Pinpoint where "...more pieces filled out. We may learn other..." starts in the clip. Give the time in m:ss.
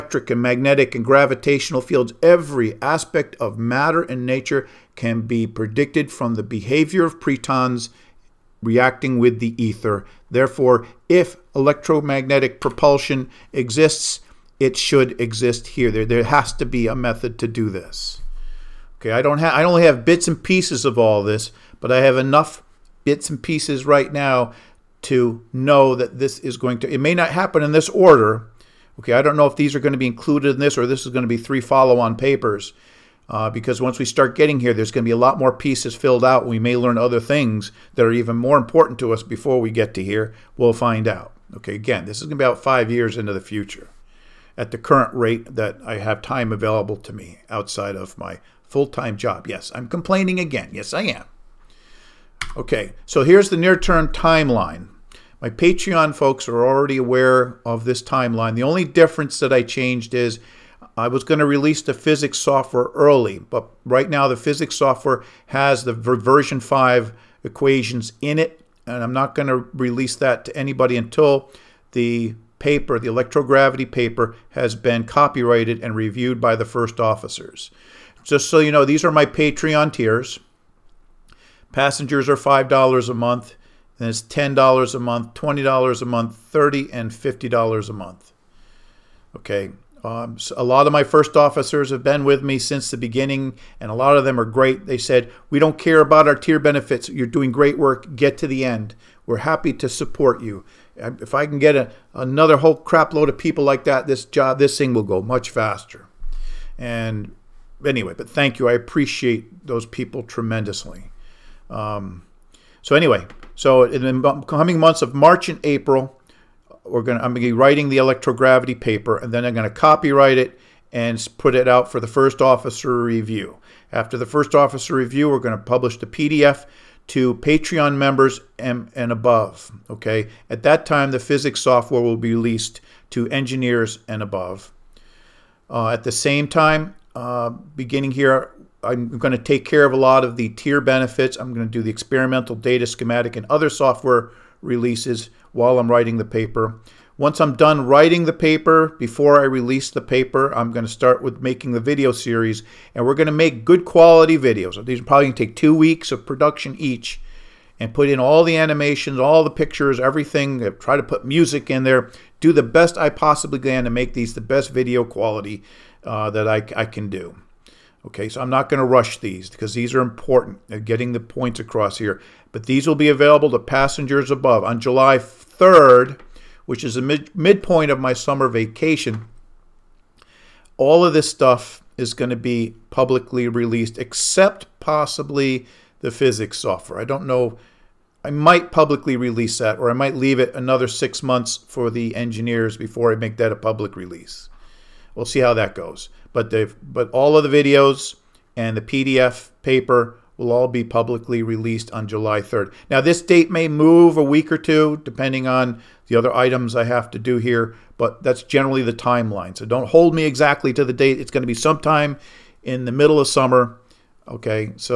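0:35.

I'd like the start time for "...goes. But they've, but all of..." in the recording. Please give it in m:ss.
3:15.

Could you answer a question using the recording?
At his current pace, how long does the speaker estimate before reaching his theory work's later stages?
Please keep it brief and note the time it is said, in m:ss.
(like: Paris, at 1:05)
5 years, at 0:42.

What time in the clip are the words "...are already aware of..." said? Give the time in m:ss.
0:56.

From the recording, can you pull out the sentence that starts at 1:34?
They said, We don't care about our tier benefits.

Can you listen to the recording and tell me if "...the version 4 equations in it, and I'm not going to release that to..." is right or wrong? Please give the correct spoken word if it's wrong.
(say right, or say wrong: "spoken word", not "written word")
wrong: "5", not "4".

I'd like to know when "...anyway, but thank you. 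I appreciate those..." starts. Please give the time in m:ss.
1:47.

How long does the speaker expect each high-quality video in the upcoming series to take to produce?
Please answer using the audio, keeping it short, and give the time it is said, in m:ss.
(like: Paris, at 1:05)
2 weeks, at 2:35.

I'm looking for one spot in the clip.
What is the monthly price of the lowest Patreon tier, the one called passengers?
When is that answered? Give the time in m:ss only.
1:22.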